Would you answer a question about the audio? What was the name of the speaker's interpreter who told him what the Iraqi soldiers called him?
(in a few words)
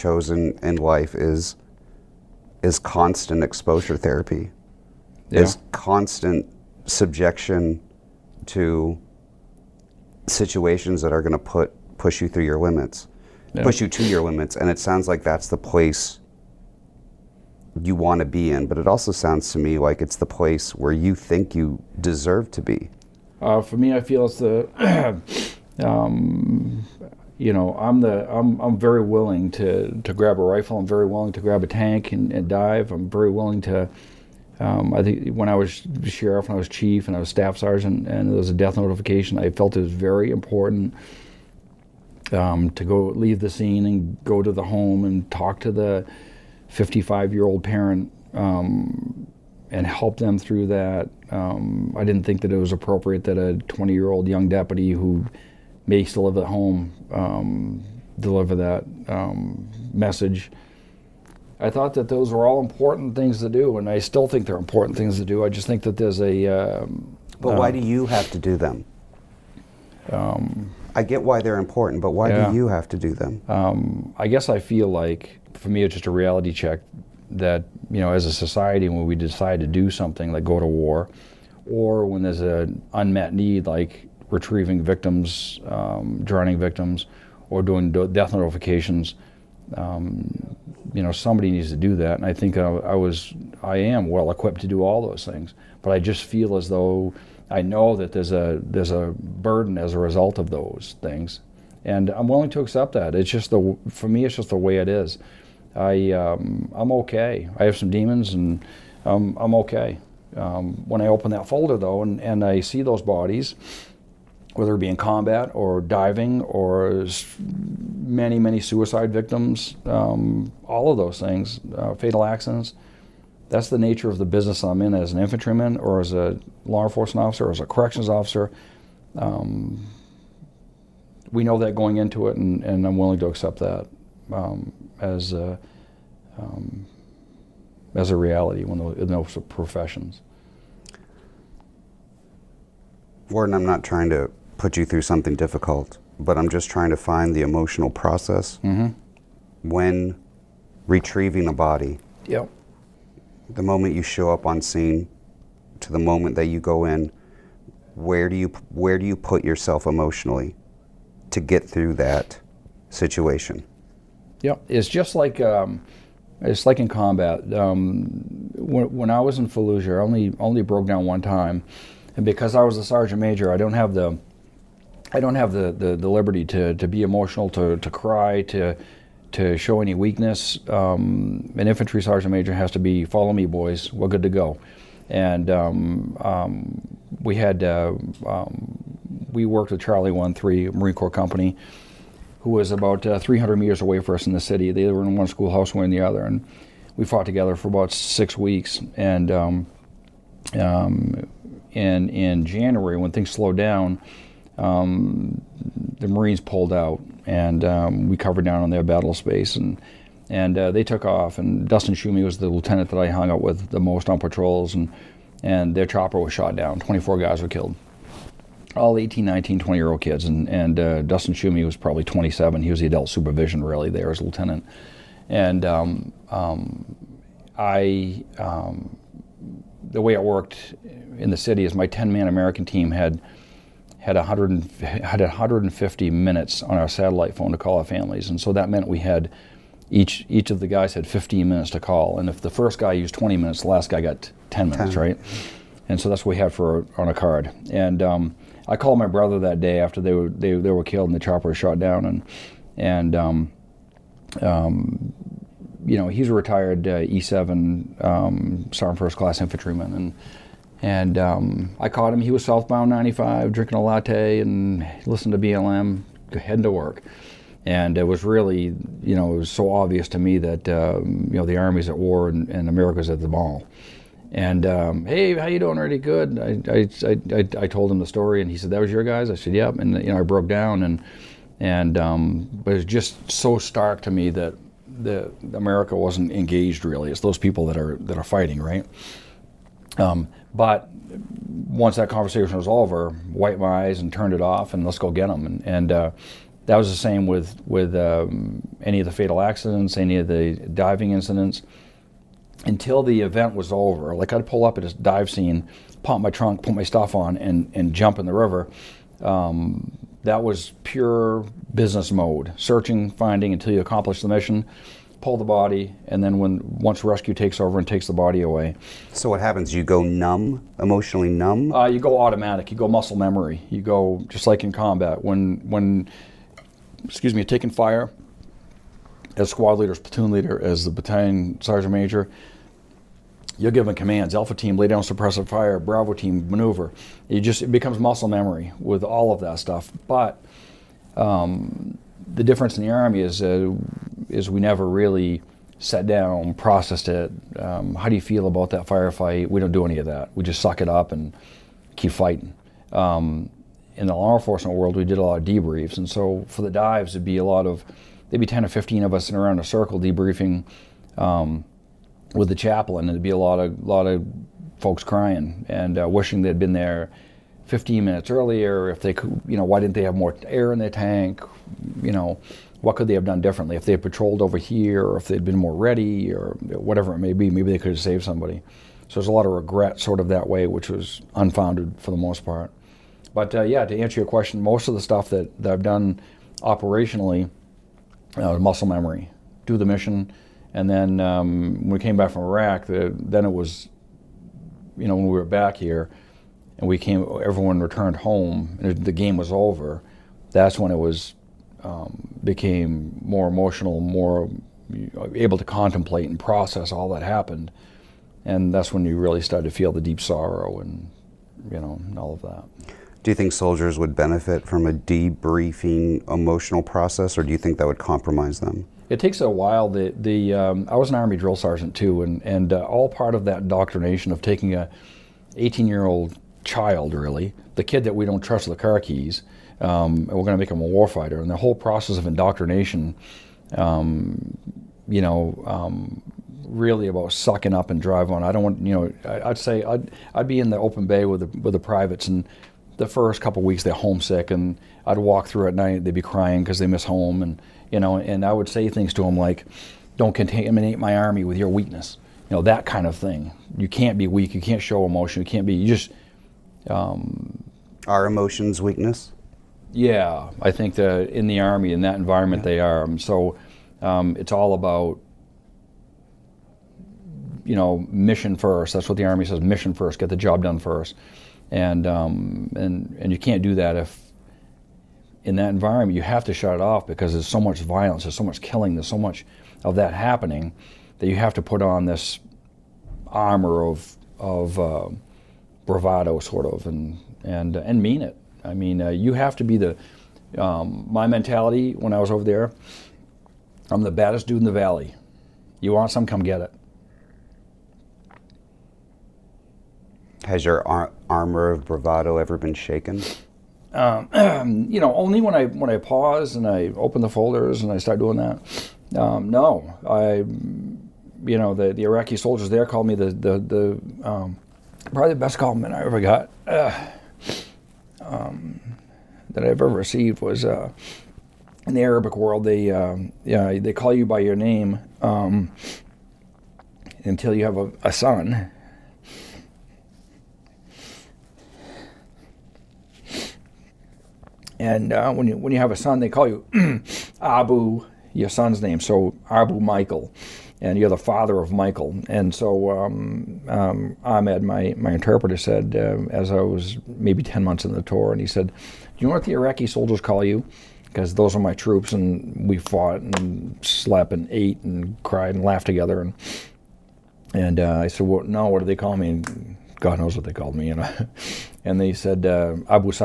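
Ahmed.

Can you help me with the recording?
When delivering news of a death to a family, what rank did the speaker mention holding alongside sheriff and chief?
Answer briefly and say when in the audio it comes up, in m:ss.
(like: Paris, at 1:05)
staff sergeant, at 0:37.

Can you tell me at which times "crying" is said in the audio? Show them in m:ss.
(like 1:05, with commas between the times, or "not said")
6:05, 7:26.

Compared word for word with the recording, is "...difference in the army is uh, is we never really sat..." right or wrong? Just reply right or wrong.
right.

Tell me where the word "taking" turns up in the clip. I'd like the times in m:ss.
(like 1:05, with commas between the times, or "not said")
5:27, 7:04.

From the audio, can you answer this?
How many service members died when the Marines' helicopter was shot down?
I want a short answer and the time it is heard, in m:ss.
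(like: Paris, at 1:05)
24, at 3:36.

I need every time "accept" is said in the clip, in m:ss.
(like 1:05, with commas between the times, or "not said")
1:42, 2:13.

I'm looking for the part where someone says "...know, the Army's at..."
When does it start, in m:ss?
4:31.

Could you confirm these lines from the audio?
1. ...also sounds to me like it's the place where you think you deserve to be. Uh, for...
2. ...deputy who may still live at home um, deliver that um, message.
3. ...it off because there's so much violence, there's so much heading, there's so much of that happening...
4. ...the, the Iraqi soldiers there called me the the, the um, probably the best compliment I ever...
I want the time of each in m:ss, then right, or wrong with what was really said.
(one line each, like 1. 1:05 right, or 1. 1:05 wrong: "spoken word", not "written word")
1. 0:18 right
2. 0:54 right
3. 7:56 wrong: "killing", not "heading"
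4. 8:31 right.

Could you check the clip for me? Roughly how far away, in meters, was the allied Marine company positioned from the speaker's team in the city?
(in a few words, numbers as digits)
300 meters.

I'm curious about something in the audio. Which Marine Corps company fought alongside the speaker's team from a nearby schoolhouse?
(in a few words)
Charlie One Three.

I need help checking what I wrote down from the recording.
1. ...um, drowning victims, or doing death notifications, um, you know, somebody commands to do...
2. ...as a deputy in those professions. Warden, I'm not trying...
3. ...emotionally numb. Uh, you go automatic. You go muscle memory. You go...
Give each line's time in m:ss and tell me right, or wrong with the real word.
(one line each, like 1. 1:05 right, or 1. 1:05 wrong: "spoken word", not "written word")
1. 1:25 wrong: "needs", not "commands"
2. 2:17 wrong: "reality", not "deputy"
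3. 5:20 right.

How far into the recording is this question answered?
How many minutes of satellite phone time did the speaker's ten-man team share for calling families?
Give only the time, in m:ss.
3:55.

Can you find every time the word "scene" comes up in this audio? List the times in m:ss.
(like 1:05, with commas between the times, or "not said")
0:43, 2:34, 5:05.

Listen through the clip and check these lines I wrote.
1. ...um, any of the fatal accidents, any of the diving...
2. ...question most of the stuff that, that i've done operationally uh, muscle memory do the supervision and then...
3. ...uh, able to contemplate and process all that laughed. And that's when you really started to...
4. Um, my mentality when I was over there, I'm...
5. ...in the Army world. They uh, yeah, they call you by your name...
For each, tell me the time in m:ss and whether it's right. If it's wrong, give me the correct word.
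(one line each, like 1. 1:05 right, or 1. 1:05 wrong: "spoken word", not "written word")
1. 4:57 right
2. 6:24 wrong: "mission", not "supervision"
3. 6:45 wrong: "happened", not "laughed"
4. 8:10 right
5. 8:41 wrong: "Arabic", not "Army".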